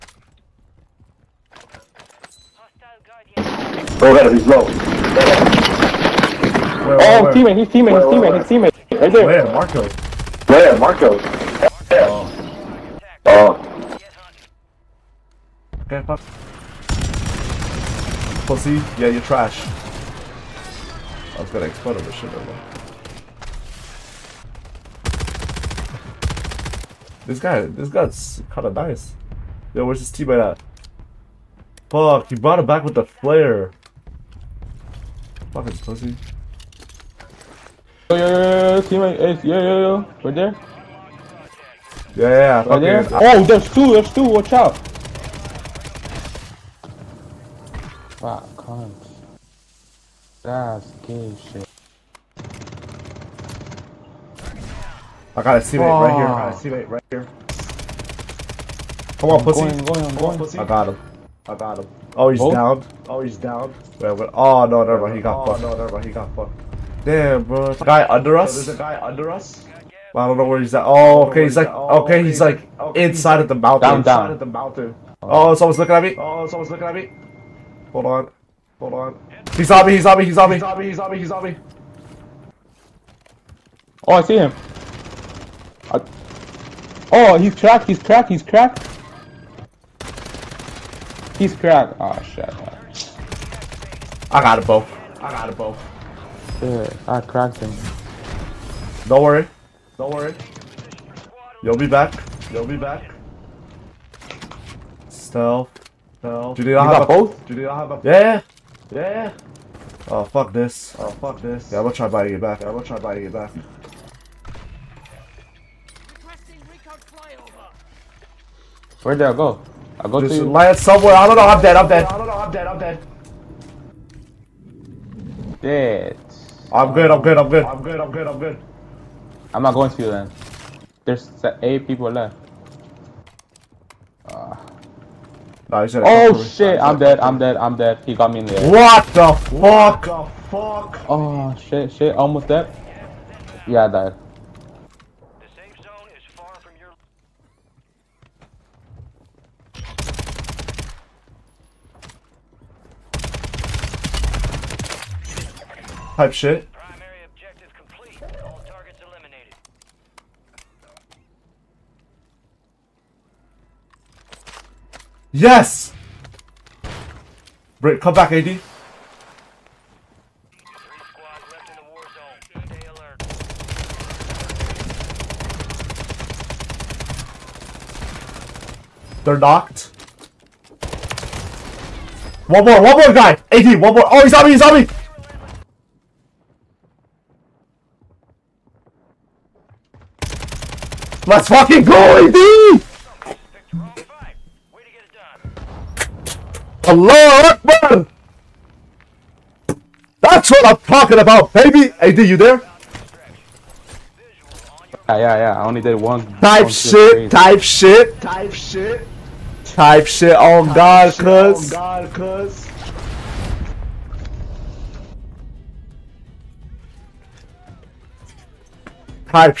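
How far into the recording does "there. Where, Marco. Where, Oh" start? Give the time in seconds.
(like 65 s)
9 s.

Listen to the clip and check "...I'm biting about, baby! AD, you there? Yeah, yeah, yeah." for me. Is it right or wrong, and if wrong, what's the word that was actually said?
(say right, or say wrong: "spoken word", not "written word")
wrong: "talking", not "biting".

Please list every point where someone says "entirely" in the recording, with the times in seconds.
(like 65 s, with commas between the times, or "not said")
not said.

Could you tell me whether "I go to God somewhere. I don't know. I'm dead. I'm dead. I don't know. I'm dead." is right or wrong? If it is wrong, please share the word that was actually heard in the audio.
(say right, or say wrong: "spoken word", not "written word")
wrong: "Land", not "God".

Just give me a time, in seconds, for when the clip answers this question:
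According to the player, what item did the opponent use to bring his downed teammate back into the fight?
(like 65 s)
32 s.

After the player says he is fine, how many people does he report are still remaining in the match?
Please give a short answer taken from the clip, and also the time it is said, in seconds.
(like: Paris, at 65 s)
8, at 131 s.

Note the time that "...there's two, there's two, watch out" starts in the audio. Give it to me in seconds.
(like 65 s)
43 s.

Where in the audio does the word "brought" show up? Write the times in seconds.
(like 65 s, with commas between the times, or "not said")
32 s.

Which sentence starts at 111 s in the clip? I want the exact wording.
Yeah, I'm gonna try biting it back.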